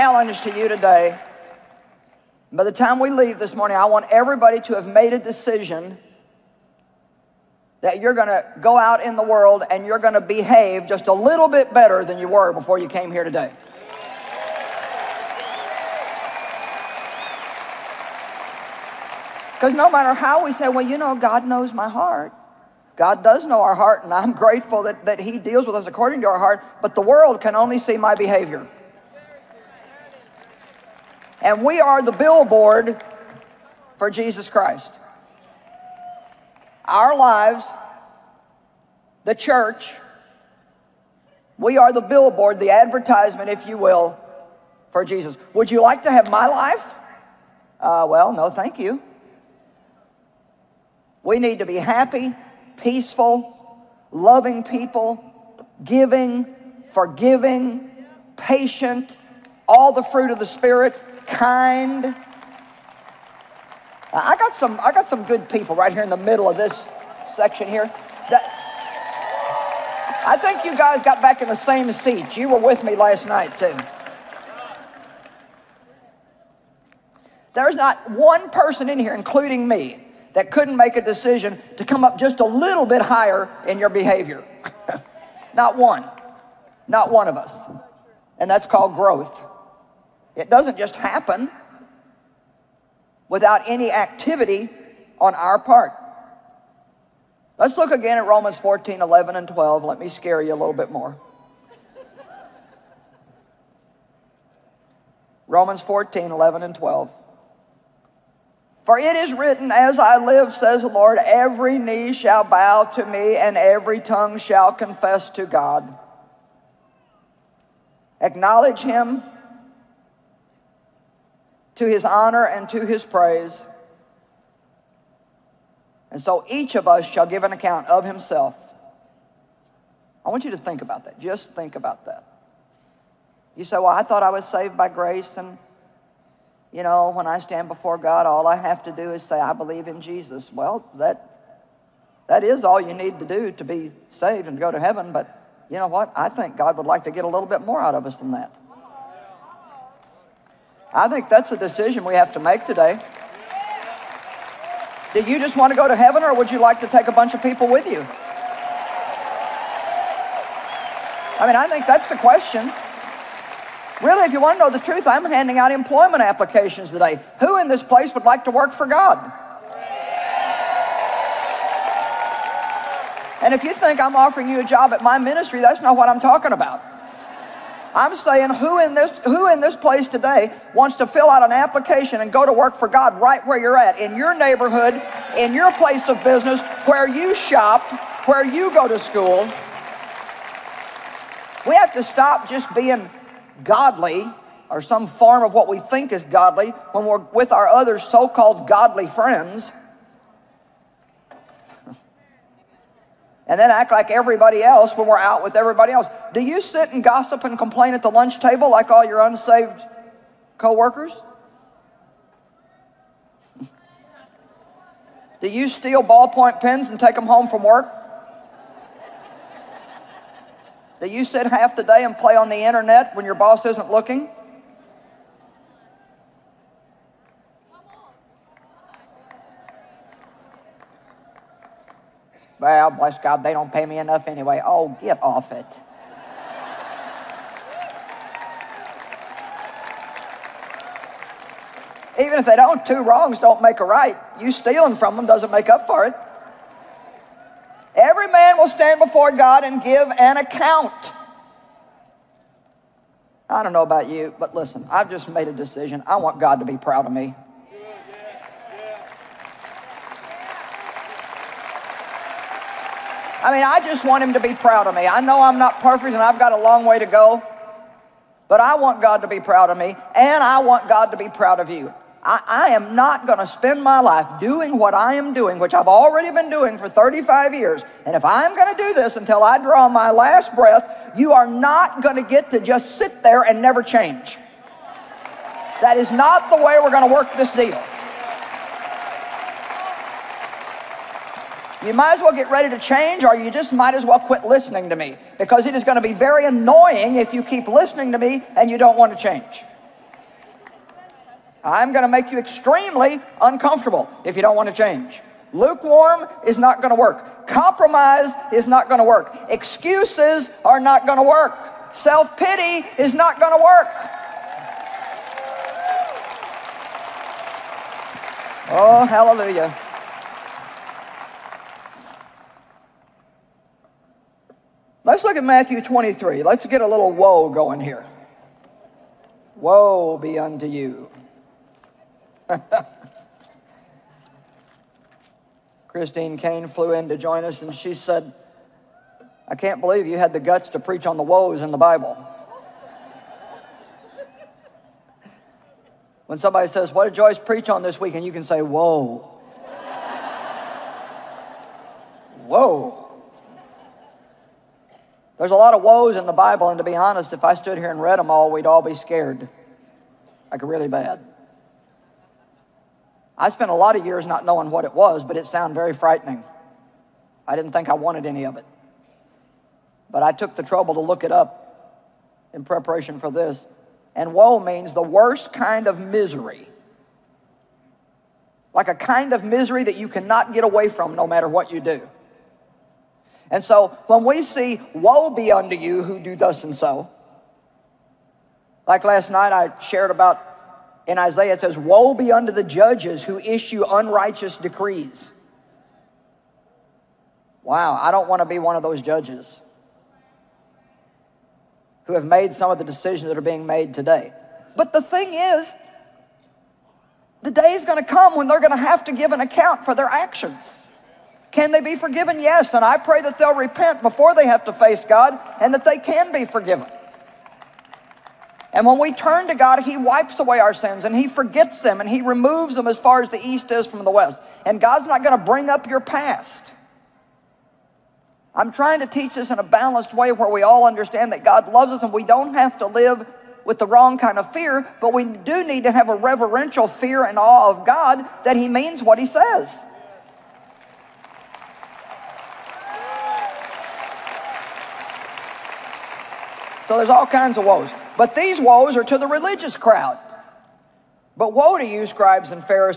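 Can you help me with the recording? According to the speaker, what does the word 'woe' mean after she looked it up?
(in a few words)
the worst kind of misery.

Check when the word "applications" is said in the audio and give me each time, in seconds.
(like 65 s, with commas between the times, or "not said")
166 s, 181 s.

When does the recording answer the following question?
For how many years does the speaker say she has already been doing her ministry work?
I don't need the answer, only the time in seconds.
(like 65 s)
276 s.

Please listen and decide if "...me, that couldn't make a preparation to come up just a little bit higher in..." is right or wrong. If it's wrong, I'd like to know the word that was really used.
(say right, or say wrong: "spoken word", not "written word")
wrong: "decision", not "preparation".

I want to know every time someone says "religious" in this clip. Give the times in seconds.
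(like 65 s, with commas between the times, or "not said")
449 s.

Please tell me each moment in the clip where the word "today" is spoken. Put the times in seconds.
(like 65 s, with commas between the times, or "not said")
0 s, 13 s, 152 s, 166 s, 180 s, 403 s.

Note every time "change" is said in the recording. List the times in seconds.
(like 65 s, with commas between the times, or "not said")
283 s, 292 s, 299 s, 304 s.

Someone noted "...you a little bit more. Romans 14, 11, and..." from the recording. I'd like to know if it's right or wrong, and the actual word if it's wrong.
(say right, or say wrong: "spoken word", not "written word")
right.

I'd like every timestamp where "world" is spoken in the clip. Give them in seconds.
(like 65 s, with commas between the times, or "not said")
9 s, 27 s.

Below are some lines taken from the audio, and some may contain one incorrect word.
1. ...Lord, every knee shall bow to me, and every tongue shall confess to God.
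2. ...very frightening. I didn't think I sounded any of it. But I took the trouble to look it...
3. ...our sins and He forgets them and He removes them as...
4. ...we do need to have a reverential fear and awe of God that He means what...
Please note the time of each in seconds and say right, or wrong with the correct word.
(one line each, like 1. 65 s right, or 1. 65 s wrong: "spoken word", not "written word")
1. 110 s right
2. 365 s wrong: "wanted", not "sounded"
3. 420 s right
4. 435 s right.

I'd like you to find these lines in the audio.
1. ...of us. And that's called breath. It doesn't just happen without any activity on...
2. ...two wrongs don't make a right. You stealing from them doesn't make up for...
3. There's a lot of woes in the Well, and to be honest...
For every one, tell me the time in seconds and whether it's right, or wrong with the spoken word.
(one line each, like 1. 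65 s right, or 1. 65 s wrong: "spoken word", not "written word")
1. 87 s wrong: "growth", not "breath"
2. 242 s right
3. 355 s wrong: "Bible", not "Well".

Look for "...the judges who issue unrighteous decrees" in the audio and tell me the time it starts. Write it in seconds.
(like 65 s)
392 s.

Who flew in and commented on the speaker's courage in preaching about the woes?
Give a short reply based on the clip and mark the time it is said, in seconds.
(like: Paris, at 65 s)
Christine Caine, at 335 s.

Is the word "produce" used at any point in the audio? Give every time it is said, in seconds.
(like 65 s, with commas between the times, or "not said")
not said.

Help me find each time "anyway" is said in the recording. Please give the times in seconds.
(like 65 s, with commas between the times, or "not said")
234 s.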